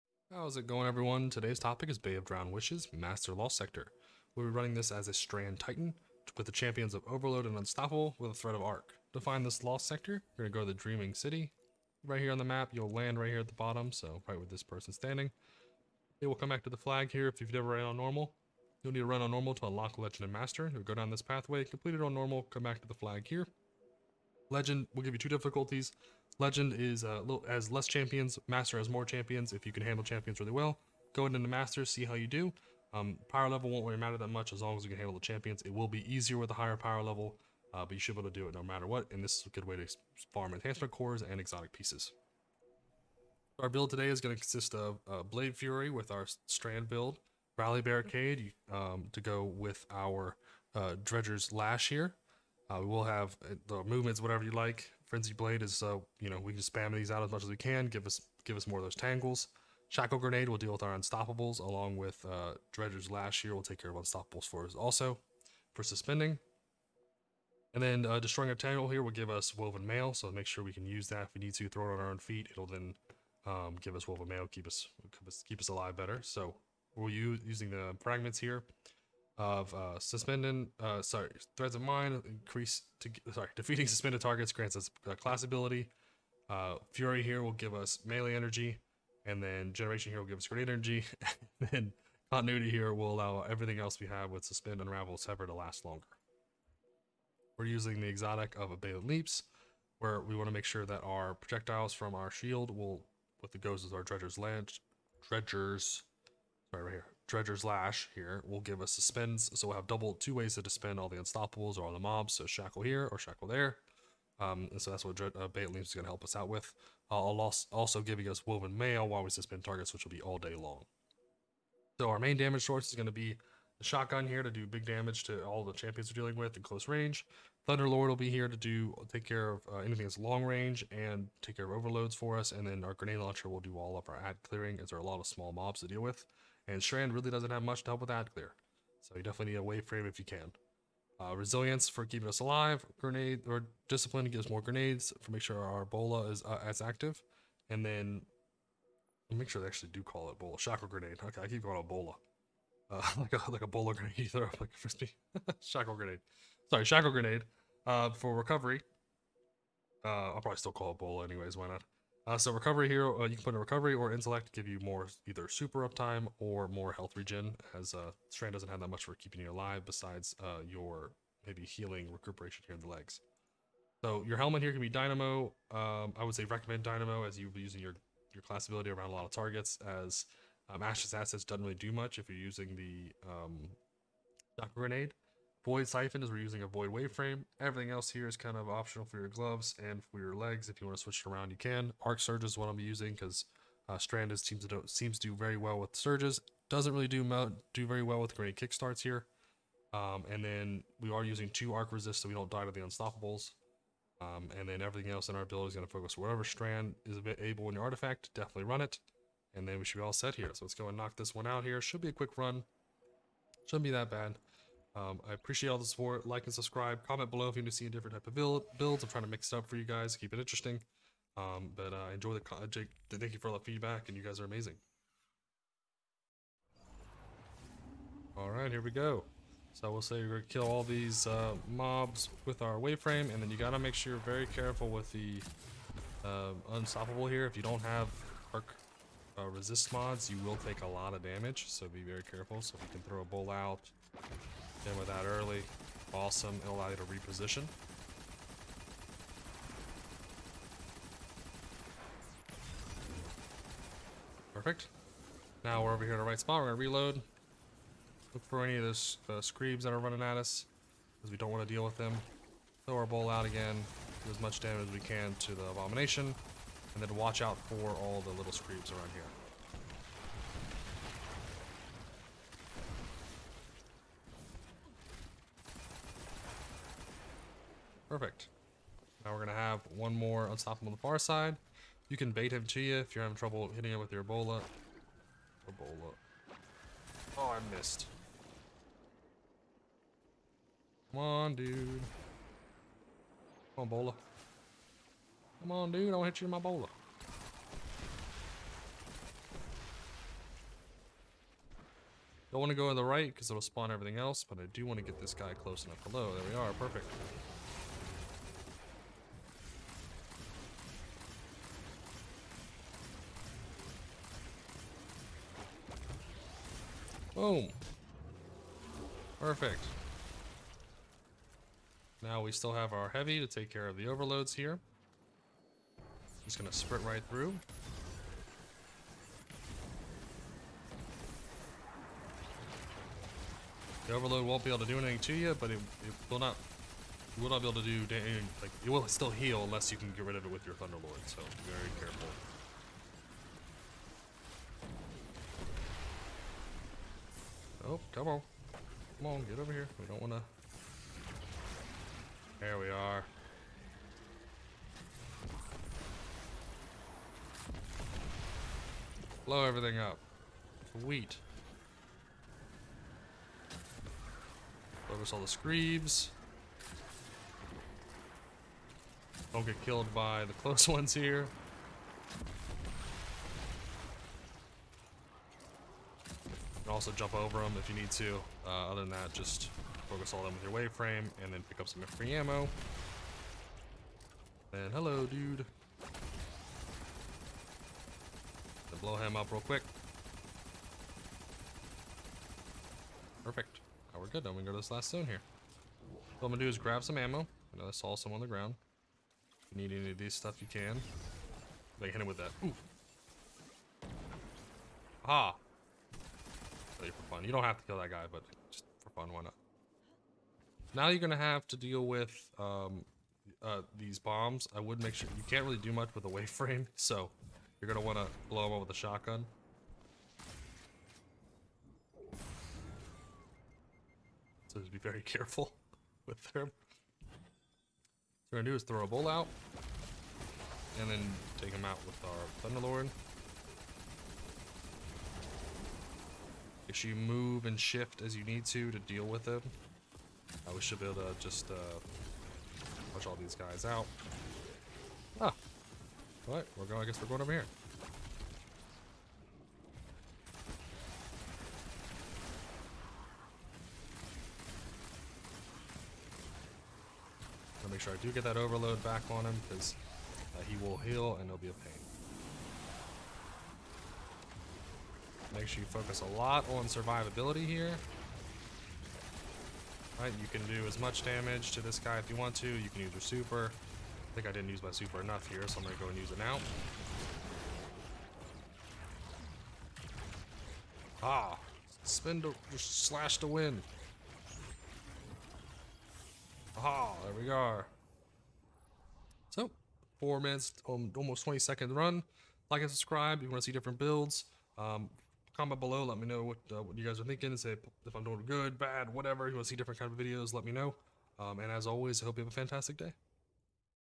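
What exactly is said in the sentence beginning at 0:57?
Give us give us more of those tangles.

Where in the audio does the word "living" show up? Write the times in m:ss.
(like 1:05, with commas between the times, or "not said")
not said.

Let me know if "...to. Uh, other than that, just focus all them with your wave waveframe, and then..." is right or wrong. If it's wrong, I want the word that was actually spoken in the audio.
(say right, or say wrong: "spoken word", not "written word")
wrong: "frame", not "waveframe".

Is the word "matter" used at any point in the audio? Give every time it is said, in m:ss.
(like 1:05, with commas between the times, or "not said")
0:33, 0:38.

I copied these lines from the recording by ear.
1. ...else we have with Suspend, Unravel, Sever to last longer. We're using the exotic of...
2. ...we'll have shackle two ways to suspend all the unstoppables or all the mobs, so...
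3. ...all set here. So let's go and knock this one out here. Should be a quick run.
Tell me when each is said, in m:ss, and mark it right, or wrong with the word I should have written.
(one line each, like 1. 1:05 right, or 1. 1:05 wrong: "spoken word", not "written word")
1. 1:33 right
2. 1:49 wrong: "double", not "shackle"
3. 3:30 right.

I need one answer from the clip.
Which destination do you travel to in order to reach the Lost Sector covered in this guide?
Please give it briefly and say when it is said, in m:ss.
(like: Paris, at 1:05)
Dreaming City, at 0:10.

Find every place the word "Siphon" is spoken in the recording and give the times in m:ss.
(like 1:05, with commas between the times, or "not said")
3:05.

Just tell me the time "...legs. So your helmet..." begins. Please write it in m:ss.
2:52.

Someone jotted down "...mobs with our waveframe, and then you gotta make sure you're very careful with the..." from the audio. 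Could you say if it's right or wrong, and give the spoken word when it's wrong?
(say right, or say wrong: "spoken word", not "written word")
right.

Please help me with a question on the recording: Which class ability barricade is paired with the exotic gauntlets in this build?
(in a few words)
Rally Barricade.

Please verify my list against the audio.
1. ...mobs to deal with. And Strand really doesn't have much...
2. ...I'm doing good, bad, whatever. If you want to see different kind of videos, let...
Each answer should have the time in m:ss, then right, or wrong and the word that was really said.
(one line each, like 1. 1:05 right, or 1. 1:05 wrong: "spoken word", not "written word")
1. 2:15 right
2. 8:18 right.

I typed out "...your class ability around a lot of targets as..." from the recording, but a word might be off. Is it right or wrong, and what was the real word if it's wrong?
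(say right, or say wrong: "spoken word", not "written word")
right.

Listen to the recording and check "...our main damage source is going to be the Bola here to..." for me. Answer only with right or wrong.
wrong.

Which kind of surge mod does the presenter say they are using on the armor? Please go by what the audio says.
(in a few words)
Arc Surge.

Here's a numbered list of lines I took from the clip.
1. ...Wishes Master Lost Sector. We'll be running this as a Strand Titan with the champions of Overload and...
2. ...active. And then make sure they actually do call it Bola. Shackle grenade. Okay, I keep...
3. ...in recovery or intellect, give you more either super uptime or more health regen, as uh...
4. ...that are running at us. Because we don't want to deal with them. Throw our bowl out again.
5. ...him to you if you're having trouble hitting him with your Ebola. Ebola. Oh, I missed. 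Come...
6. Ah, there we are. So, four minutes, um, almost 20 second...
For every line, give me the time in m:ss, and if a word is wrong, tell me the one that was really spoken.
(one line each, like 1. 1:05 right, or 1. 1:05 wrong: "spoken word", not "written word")
1. 0:02 right
2. 2:26 right
3. 2:43 right
4. 4:19 right
5. 4:42 right
6. 8:06 right.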